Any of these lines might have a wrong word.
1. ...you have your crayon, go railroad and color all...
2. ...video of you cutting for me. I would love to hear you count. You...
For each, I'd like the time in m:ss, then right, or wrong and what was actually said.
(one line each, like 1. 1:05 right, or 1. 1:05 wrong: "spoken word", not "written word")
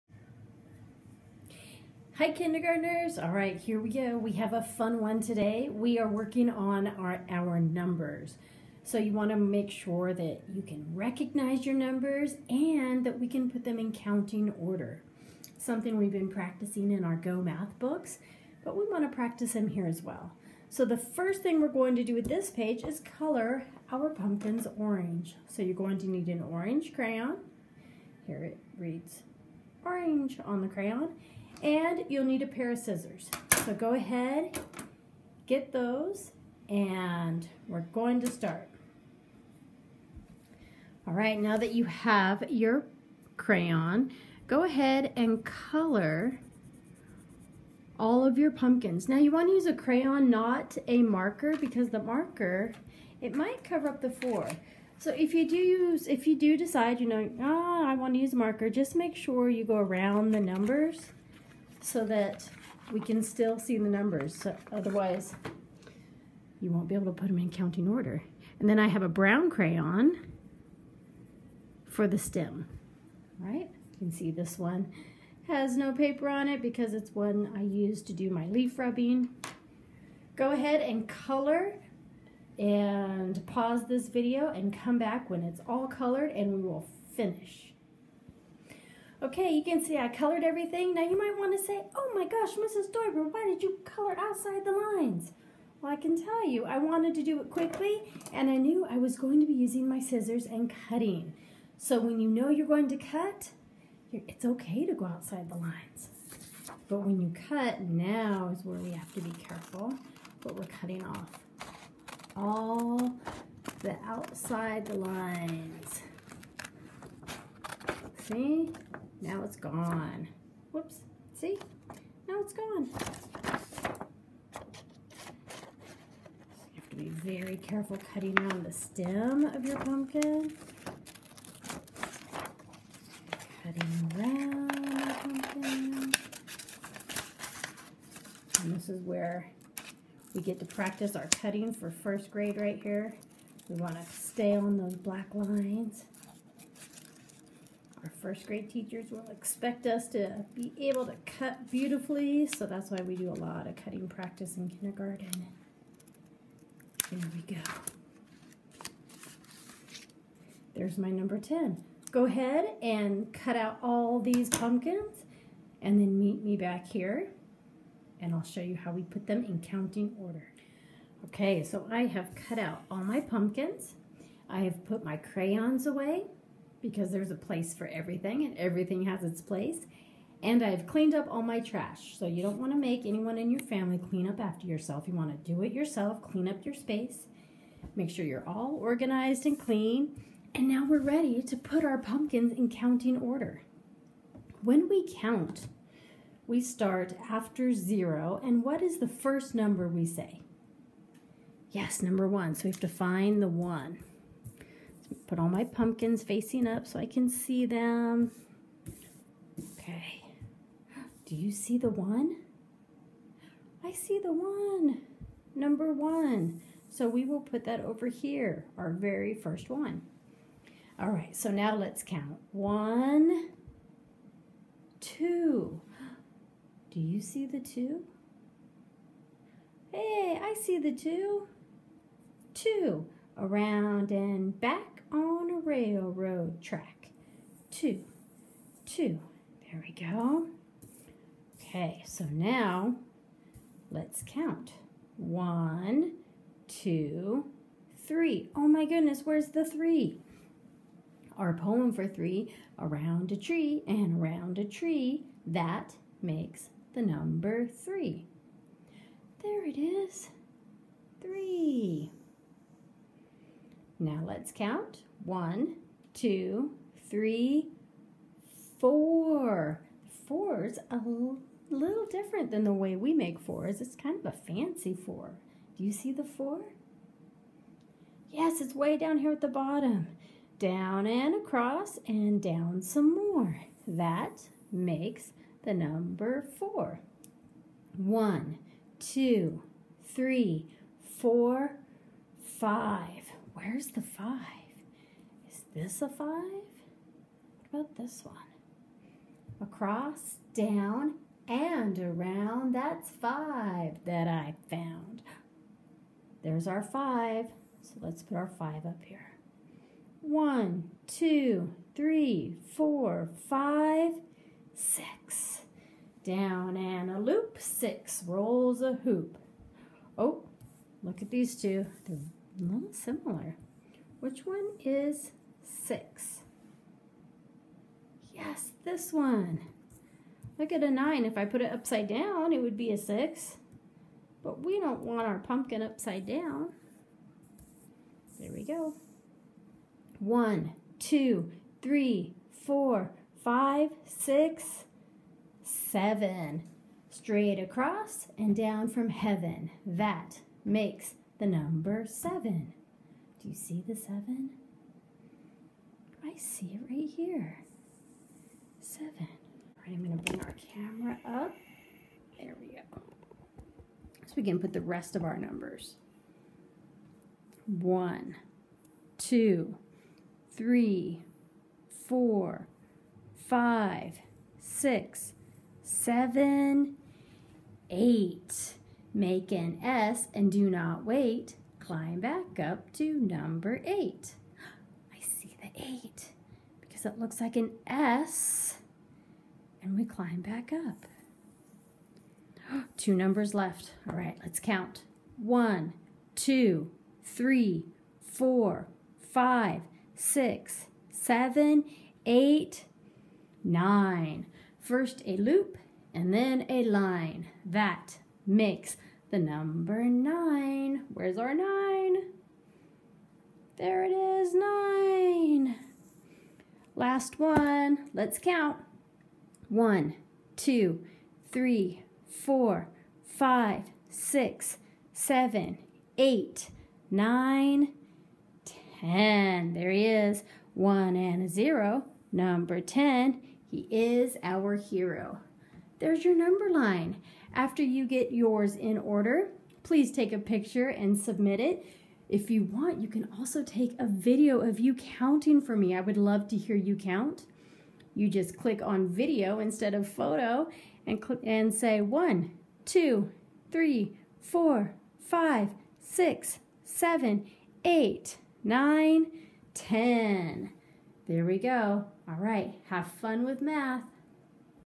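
1. 0:41 wrong: "ahead", not "railroad"
2. 7:24 wrong: "counting", not "cutting".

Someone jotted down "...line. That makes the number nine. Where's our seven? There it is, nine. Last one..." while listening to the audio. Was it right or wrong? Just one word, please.
wrong.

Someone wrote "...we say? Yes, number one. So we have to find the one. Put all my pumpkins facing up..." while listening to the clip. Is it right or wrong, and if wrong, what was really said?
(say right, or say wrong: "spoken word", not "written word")
right.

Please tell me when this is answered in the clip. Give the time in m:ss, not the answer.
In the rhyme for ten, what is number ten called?
7:14.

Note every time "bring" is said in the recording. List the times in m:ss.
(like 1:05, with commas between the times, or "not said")
6:00.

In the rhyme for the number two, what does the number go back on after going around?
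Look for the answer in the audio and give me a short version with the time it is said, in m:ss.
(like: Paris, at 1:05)
A railroad track, at 3:55.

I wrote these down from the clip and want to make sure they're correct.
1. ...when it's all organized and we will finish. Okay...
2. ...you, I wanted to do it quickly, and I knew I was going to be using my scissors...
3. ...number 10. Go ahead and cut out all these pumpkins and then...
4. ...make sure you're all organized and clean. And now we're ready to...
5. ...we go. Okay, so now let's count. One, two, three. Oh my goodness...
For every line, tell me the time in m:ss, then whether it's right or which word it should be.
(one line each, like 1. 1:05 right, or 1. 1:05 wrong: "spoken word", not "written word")
1. 1:25 wrong: "colored", not "organized"
2. 1:36 right
3. 2:41 right
4. 3:07 right
5. 3:59 right.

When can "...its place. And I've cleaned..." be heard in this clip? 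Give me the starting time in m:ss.
2:59.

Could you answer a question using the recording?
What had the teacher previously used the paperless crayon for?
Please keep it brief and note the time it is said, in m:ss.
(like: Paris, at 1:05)
Leaf rubbing, at 1:18.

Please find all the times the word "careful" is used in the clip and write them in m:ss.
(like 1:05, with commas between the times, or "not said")
1:49, 2:07.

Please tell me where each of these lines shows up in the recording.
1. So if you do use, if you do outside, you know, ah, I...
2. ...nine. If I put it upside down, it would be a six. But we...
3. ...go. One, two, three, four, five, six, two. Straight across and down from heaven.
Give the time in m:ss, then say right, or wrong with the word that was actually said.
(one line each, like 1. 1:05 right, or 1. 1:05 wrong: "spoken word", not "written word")
1. 0:54 wrong: "decide", not "outside"
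2. 5:30 right
3. 5:38 wrong: "seven", not "two".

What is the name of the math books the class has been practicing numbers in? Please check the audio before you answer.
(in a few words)
Go Math.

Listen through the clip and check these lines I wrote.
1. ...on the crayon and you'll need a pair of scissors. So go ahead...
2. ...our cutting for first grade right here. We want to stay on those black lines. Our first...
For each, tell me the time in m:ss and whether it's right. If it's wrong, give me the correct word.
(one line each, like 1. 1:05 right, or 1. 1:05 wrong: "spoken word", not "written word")
1. 0:30 right
2. 2:21 right.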